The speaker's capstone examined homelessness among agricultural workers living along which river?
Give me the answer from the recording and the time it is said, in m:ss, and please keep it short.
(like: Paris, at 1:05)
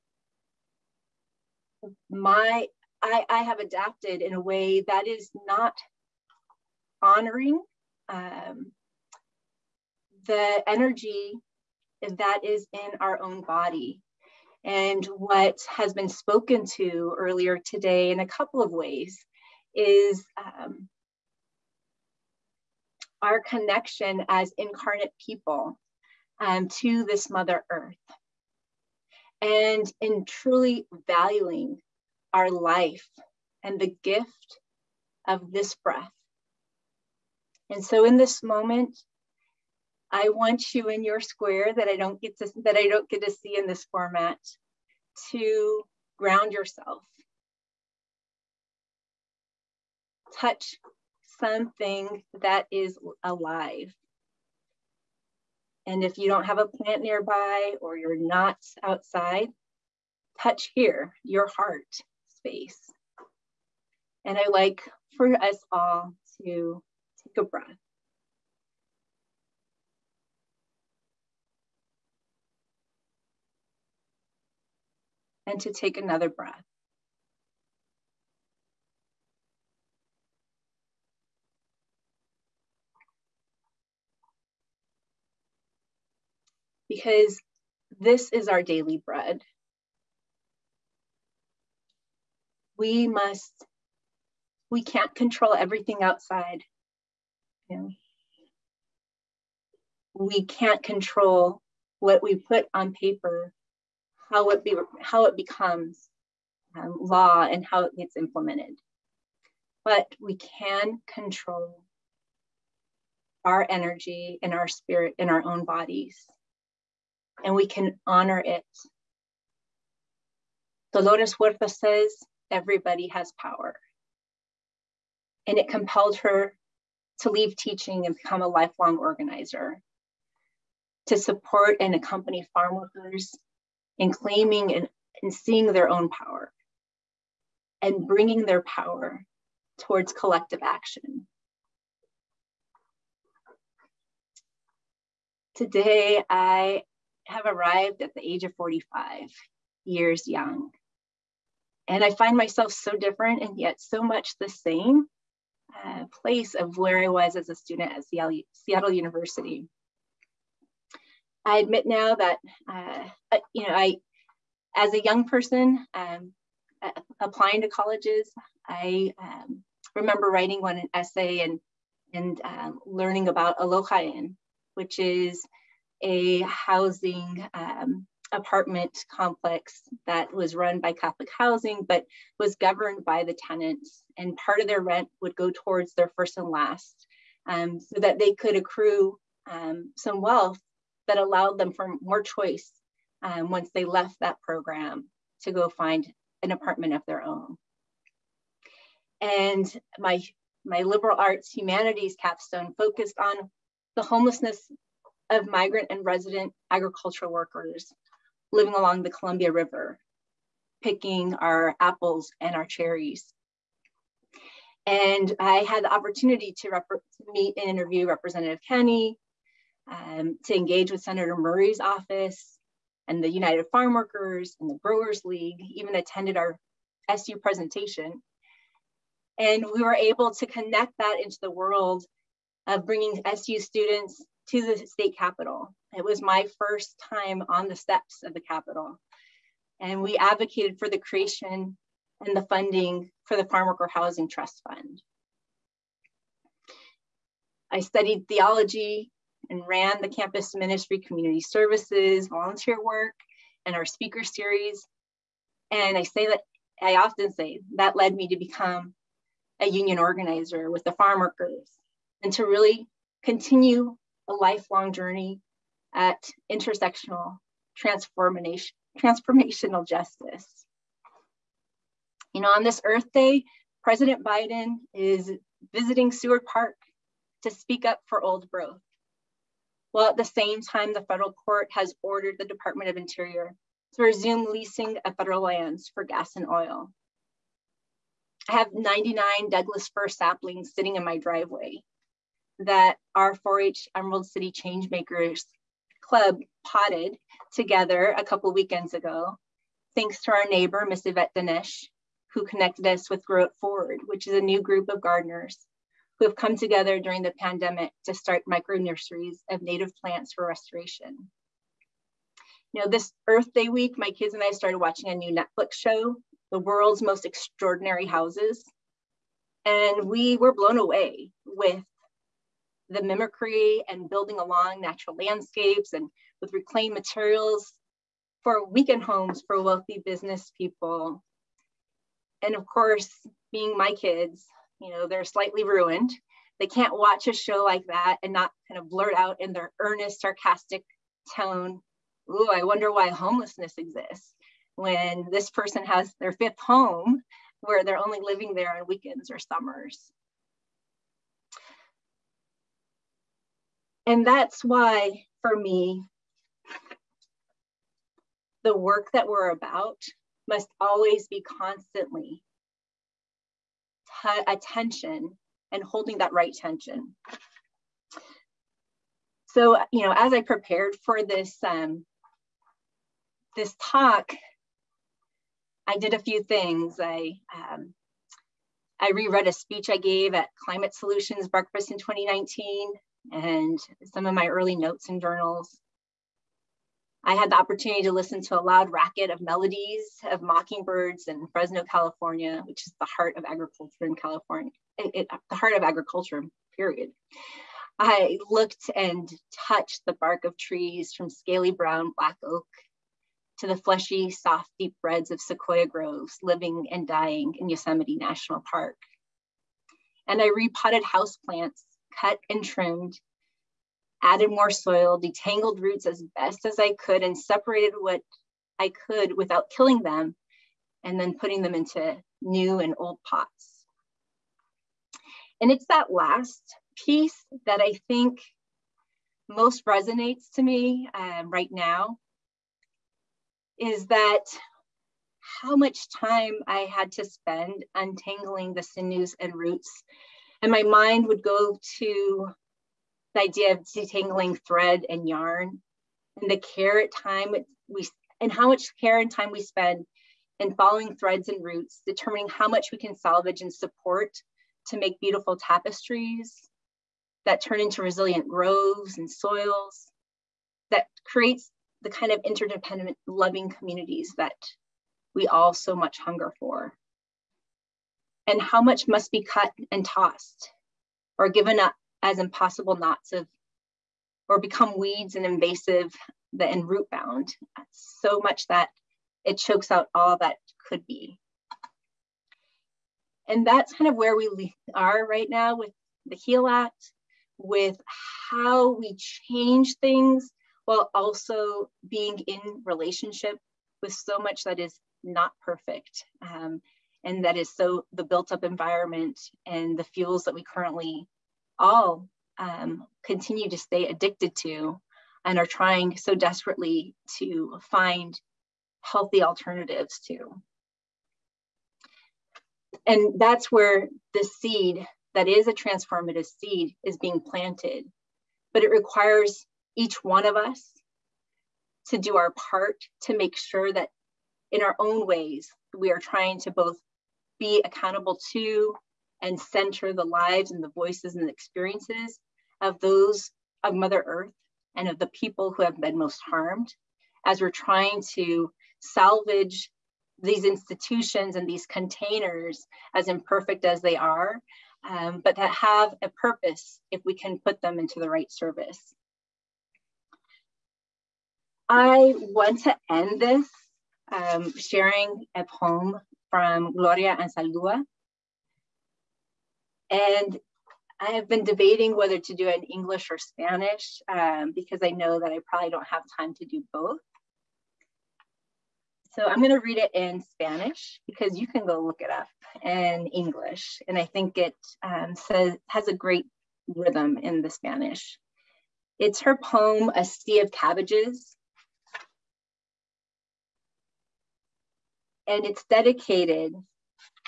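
Columbia River, at 3:29.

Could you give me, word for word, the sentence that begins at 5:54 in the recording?
And that's why, for me, the work that we're about must always be constantly a tension and holding that right tension.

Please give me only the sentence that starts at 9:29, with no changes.
So I'm going to read it in Spanish because you can go look it up in English.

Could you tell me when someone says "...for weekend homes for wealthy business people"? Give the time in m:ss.
5:28.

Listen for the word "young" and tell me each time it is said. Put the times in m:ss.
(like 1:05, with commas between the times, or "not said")
2:30, 2:45.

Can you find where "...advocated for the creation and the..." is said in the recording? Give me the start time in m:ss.
4:00.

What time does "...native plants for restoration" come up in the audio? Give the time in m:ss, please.
5:09.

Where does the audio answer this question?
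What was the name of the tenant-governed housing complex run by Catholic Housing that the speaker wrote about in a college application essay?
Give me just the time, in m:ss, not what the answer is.
2:53.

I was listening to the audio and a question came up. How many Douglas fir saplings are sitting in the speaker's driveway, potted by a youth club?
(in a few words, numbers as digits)
99.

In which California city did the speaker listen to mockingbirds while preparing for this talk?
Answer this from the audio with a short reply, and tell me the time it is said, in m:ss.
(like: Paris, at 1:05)
Fresno, at 6:31.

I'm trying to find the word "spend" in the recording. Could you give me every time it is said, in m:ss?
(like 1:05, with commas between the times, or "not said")
7:17, 7:29.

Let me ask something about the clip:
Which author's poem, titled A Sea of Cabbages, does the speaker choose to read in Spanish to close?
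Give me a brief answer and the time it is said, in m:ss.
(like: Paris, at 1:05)
Gloria Anzaldúa, at 9:16.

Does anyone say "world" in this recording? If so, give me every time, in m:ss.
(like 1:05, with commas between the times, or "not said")
3:51, 5:16.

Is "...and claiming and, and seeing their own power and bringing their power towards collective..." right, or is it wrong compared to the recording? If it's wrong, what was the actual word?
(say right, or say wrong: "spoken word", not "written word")
right.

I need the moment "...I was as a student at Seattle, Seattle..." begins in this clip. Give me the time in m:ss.
2:36.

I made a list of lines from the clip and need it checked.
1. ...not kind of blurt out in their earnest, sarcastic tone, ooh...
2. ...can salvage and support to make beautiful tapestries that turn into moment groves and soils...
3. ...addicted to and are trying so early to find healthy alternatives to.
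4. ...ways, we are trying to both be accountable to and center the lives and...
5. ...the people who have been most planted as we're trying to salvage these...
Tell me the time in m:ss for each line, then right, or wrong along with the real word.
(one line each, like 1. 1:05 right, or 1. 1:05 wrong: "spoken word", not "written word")
1. 5:38 right
2. 7:32 wrong: "resilient", not "moment"
3. 8:24 wrong: "desperately", not "early"
4. 8:45 right
5. 8:55 wrong: "harmed", not "planted".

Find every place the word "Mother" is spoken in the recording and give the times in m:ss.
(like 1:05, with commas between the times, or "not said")
0:27, 8:53.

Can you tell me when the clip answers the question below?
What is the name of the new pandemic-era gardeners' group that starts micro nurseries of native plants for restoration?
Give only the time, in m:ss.
5:03.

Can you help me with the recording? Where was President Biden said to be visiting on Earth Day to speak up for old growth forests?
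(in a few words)
Seward Park.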